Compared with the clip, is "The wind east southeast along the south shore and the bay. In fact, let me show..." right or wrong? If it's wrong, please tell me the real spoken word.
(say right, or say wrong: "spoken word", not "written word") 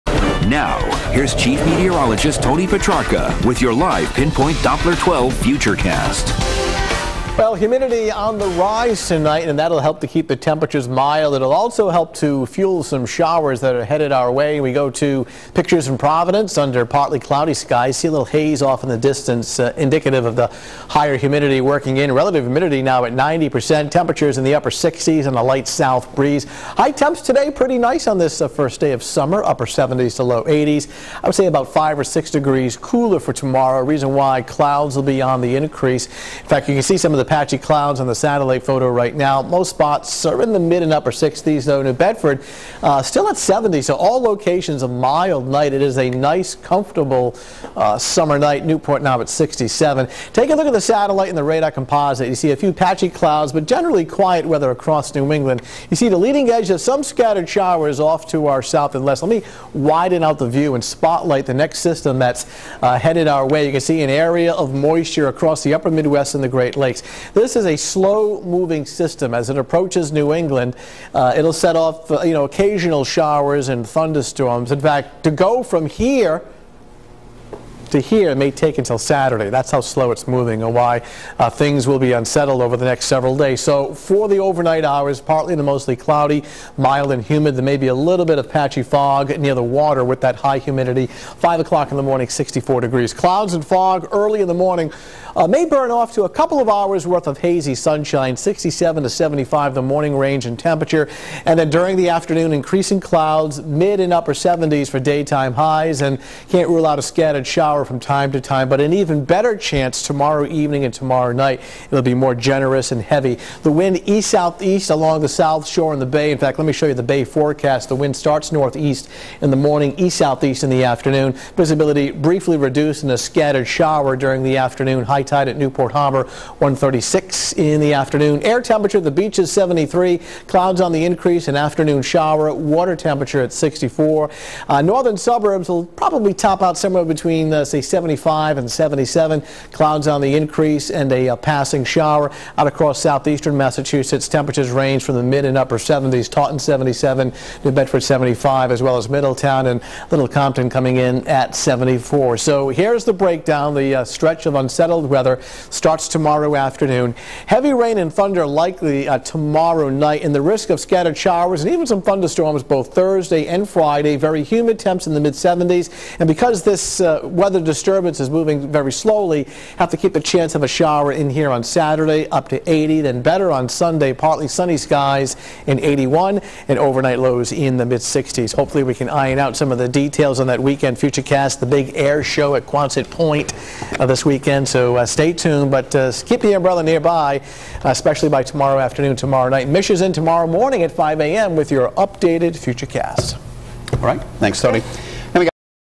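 right.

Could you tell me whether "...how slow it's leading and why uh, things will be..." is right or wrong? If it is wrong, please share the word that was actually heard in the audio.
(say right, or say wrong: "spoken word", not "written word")
wrong: "moving", not "leading".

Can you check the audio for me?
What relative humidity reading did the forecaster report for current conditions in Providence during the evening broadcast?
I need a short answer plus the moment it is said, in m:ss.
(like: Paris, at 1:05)
90%, at 0:23.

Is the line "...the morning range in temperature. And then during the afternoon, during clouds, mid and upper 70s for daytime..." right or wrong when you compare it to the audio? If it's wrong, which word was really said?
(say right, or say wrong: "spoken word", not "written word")
wrong: "increasing", not "during".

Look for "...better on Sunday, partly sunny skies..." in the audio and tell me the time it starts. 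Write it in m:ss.
2:53.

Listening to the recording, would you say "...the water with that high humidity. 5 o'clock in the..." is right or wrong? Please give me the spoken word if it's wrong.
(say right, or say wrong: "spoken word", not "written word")
right.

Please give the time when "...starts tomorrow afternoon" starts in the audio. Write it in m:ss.
2:35.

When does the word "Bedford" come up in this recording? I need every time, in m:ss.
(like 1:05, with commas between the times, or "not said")
0:41, 2:27.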